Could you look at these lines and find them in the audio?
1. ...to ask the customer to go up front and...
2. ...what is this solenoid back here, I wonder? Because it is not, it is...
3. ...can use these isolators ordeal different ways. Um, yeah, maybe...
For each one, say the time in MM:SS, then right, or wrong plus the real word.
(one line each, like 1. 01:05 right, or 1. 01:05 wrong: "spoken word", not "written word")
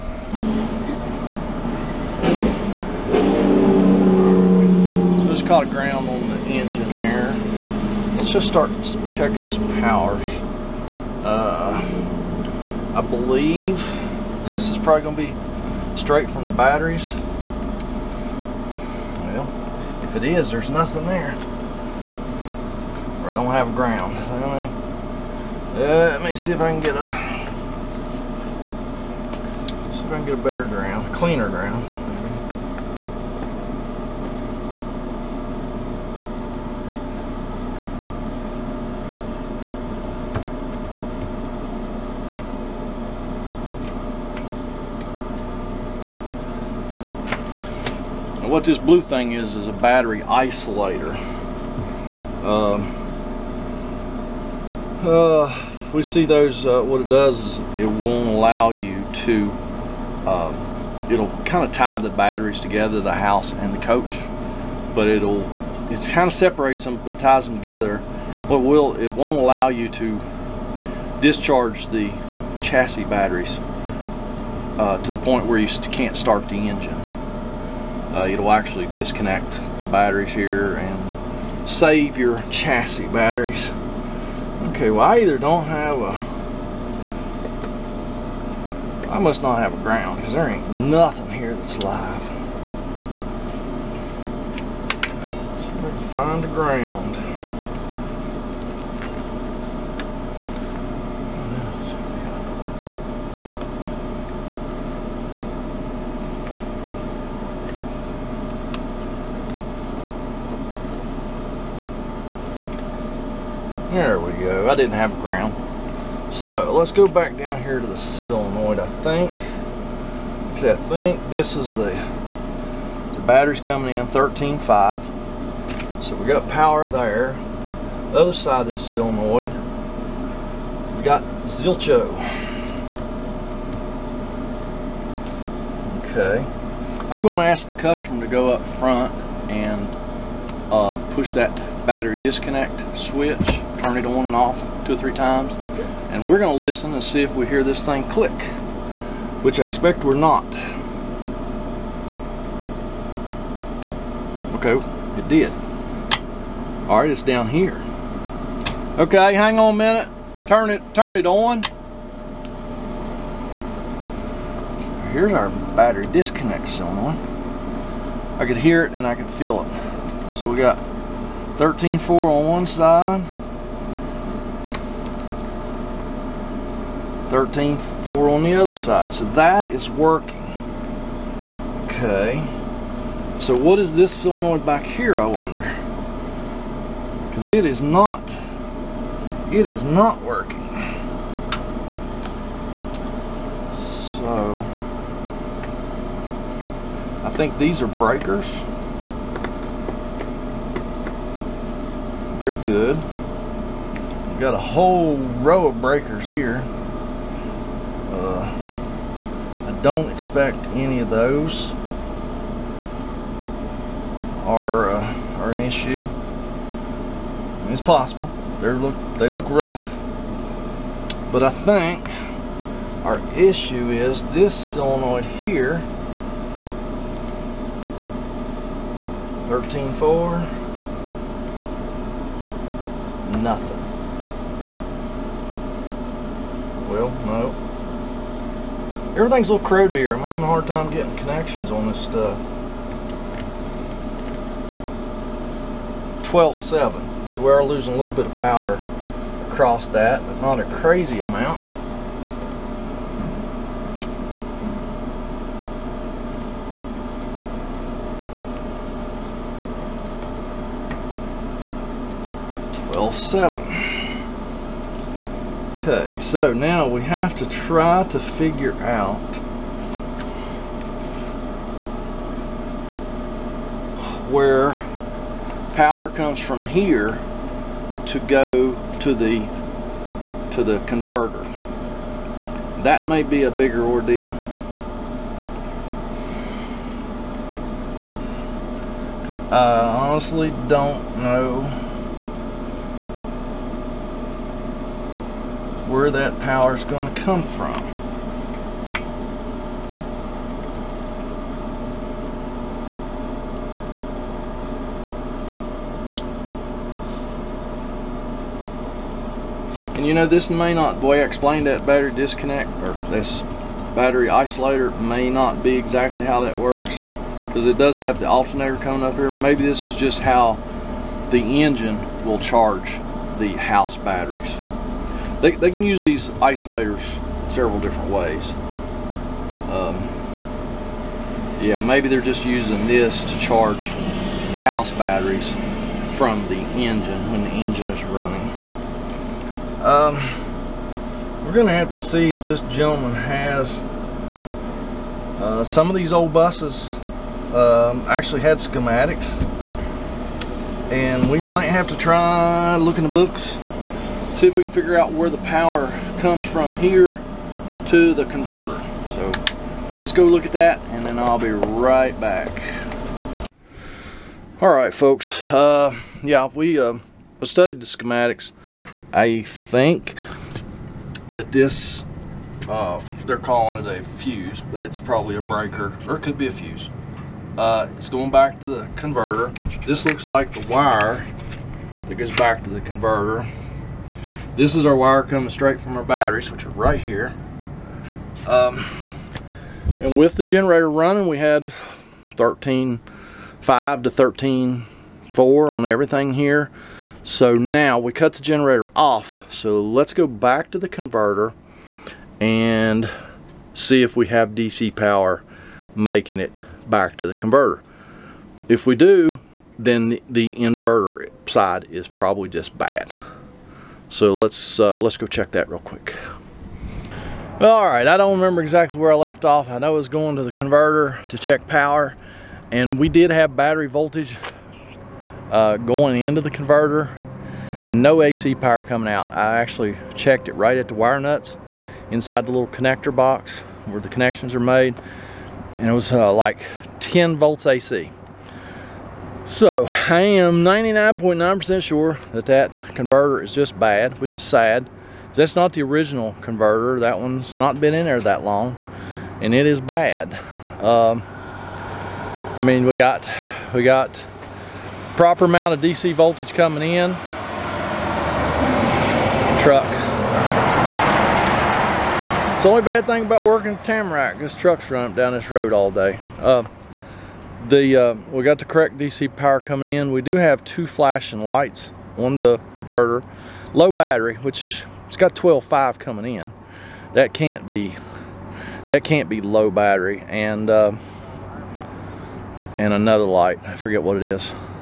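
1. 02:17 right
2. 03:03 right
3. 05:25 wrong: "several", not "ordeal".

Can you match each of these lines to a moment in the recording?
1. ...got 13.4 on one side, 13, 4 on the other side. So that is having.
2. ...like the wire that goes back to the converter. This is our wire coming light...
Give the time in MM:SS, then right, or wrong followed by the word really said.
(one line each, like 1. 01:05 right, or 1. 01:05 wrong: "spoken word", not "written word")
1. 02:50 wrong: "working", not "having"
2. 06:20 wrong: "straight", not "light".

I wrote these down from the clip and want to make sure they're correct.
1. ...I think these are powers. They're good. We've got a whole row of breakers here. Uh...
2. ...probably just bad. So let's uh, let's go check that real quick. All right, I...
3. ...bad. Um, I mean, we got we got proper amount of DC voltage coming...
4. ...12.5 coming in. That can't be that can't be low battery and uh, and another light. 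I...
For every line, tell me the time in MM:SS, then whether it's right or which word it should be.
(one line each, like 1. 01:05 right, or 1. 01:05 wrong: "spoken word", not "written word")
1. 03:17 wrong: "breakers", not "powers"
2. 06:52 right
3. 07:29 right
4. 07:55 right.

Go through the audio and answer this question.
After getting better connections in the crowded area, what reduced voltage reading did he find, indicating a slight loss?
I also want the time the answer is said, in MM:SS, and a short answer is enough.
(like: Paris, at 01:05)
12.7, at 04:06.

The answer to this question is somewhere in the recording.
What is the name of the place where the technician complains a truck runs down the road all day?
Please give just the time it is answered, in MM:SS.
07:43.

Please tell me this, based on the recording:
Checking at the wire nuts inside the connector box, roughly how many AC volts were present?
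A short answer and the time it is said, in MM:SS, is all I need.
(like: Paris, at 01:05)
10 volts, at 07:17.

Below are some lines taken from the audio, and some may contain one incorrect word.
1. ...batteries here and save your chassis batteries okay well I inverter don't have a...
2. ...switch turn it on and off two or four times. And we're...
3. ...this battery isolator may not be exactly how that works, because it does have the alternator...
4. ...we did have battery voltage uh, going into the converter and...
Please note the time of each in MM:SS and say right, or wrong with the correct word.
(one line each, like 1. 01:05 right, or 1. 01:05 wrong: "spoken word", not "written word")
1. 01:19 wrong: "either", not "inverter"
2. 02:22 wrong: "three", not "four"
3. 05:13 right
4. 07:02 right.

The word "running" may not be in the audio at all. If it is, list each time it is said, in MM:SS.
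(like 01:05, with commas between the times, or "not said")
05:38, 06:30, 07:44.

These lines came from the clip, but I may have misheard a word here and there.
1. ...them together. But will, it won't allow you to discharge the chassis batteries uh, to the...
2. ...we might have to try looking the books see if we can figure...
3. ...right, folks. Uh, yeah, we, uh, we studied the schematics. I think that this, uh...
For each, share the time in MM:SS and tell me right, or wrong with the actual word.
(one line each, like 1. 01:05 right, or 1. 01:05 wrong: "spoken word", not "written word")
1. 01:07 right
2. 05:51 right
3. 06:04 right.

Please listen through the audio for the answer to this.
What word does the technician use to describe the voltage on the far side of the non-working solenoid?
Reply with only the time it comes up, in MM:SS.
02:11.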